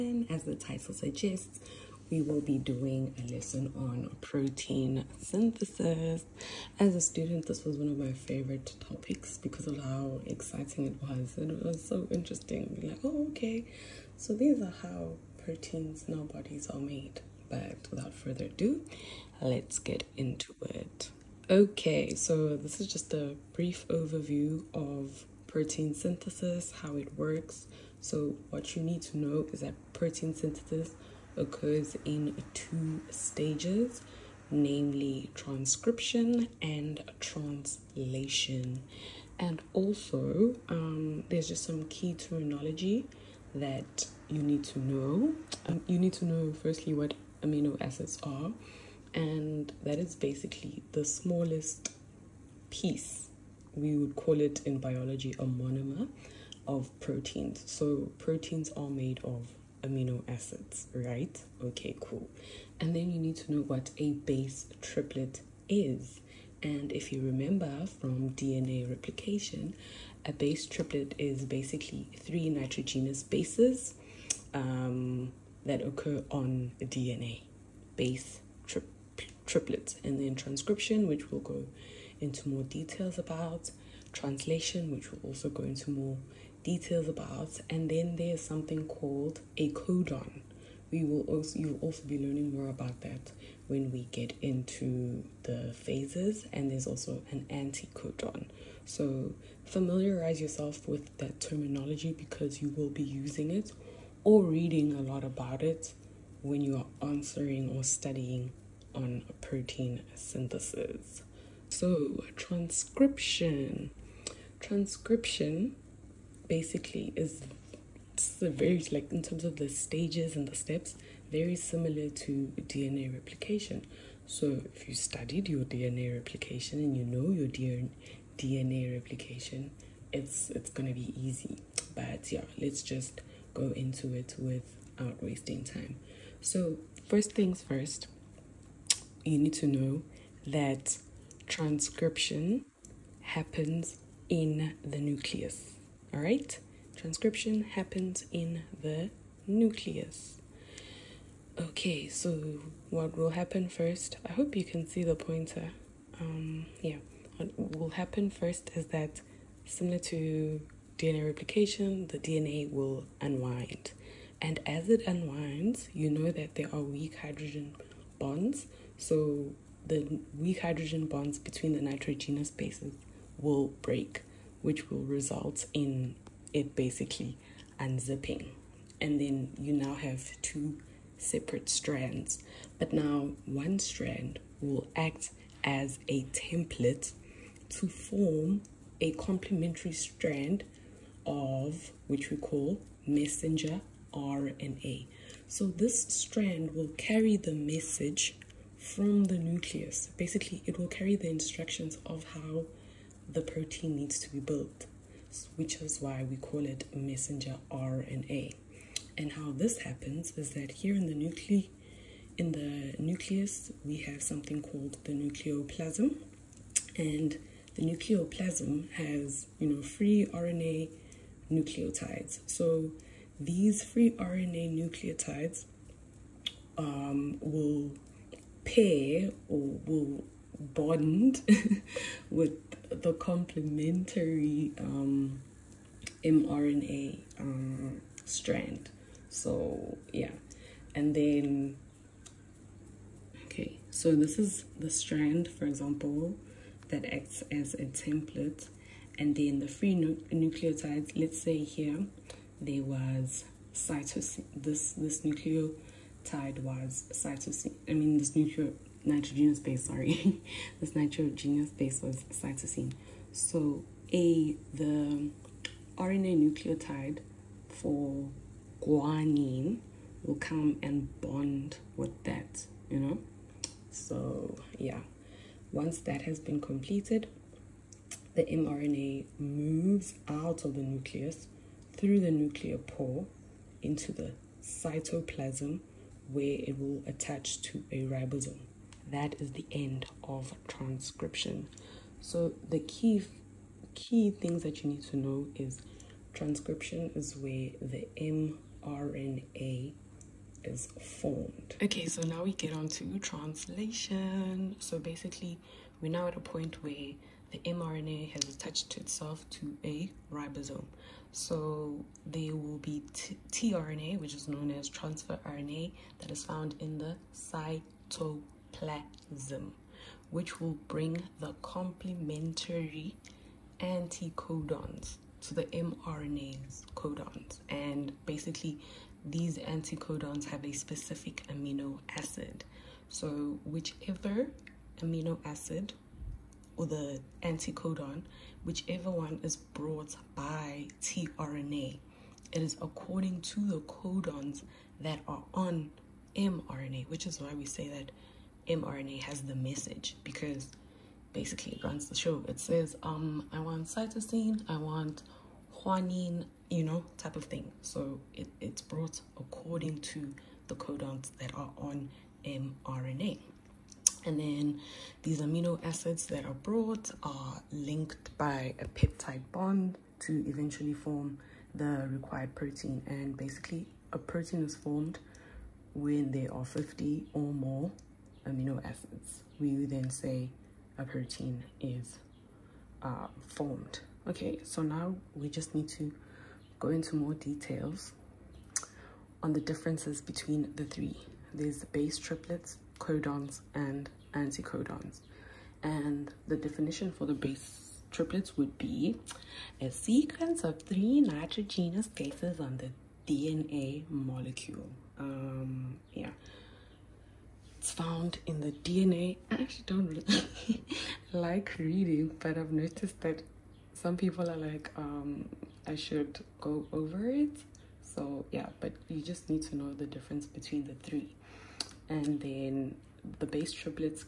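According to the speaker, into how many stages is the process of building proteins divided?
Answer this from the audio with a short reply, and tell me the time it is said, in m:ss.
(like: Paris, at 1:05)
2, at 0:32.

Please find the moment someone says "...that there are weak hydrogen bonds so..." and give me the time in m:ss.
2:46.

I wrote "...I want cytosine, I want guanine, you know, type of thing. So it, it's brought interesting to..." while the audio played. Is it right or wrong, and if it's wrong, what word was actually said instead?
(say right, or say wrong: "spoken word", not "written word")
wrong: "according", not "interesting".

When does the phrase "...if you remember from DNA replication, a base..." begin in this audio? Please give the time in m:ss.
1:06.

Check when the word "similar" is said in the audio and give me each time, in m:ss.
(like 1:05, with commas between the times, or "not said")
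2:01, 2:39.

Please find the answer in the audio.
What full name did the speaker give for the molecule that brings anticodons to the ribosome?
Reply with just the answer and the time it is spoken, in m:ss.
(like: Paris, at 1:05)
transfer RNA, at 5:14.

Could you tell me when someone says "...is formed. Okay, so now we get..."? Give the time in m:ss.
5:00.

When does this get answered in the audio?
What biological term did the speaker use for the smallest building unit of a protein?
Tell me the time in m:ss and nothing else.
0:55.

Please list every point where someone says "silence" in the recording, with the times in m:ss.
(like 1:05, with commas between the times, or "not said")
not said.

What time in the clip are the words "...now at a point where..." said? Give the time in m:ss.
5:06.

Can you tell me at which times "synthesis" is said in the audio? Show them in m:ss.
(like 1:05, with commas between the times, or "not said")
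0:05, 0:25, 0:30, 1:50.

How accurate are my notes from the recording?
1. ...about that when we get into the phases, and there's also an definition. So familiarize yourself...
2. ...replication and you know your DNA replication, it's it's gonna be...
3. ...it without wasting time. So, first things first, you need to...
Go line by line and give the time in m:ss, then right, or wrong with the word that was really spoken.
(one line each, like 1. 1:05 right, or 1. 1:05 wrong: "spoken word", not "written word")
1. 1:32 wrong: "anticodon", not "definition"
2. 2:06 right
3. 2:14 right.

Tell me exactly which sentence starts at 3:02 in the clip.
But now one strand will act as a template to form a complementary strand of which we call messenger RNA.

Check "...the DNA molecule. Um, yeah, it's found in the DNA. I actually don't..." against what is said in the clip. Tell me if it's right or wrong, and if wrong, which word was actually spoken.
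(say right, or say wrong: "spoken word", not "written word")
right.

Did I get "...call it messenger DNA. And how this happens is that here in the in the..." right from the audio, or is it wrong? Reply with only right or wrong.
wrong.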